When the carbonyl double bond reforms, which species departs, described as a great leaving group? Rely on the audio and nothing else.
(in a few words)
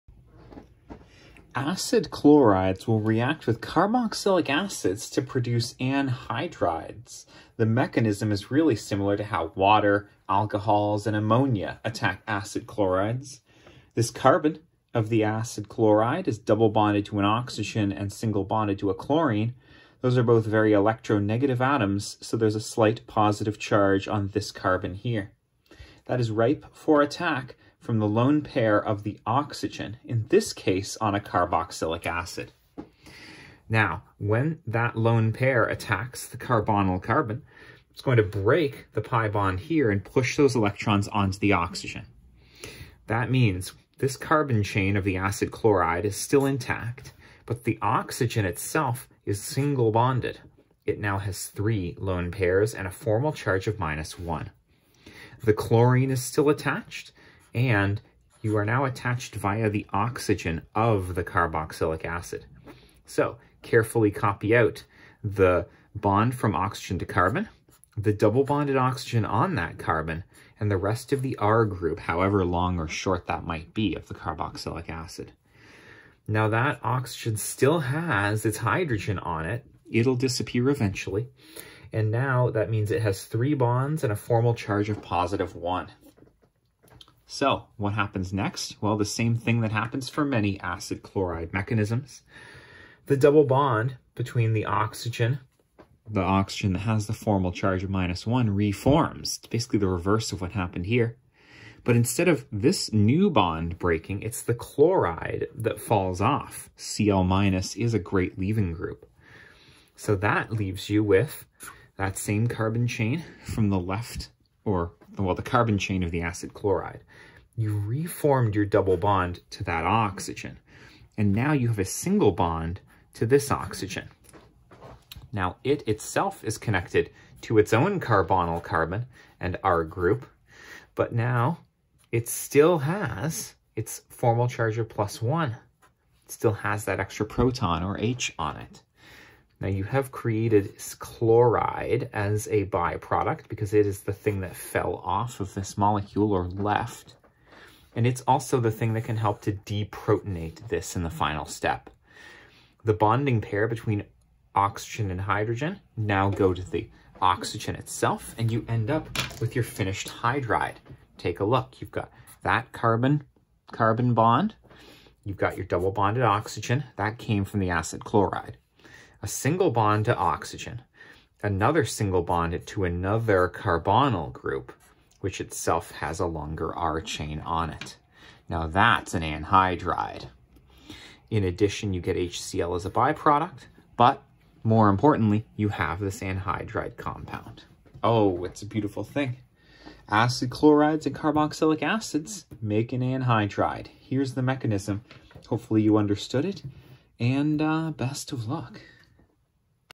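Cl minus.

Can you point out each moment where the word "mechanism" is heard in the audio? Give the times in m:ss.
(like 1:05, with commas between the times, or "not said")
0:07, 1:31, 3:14.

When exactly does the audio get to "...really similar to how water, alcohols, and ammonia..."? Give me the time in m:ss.
0:08.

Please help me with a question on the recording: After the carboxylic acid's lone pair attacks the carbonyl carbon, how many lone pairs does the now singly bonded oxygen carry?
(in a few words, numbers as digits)
3.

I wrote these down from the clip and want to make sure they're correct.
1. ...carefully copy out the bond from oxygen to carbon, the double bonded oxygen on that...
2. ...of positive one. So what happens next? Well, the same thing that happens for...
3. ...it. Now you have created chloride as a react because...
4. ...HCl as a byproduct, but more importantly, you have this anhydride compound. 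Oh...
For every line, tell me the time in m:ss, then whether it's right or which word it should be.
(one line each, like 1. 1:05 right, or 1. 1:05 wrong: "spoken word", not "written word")
1. 1:03 right
2. 1:24 right
3. 2:18 wrong: "byproduct", not "react"
4. 3:02 right.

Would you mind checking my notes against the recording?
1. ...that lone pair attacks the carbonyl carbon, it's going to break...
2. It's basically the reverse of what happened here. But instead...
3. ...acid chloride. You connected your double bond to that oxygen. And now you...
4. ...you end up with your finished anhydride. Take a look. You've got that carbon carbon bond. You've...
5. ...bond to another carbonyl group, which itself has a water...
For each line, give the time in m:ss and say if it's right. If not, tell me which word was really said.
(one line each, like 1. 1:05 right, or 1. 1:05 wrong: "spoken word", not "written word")
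1. 0:34 right
2. 1:39 right
3. 1:56 wrong: "reformed", not "connected"
4. 2:38 right
5. 2:52 wrong: "longer", not "water".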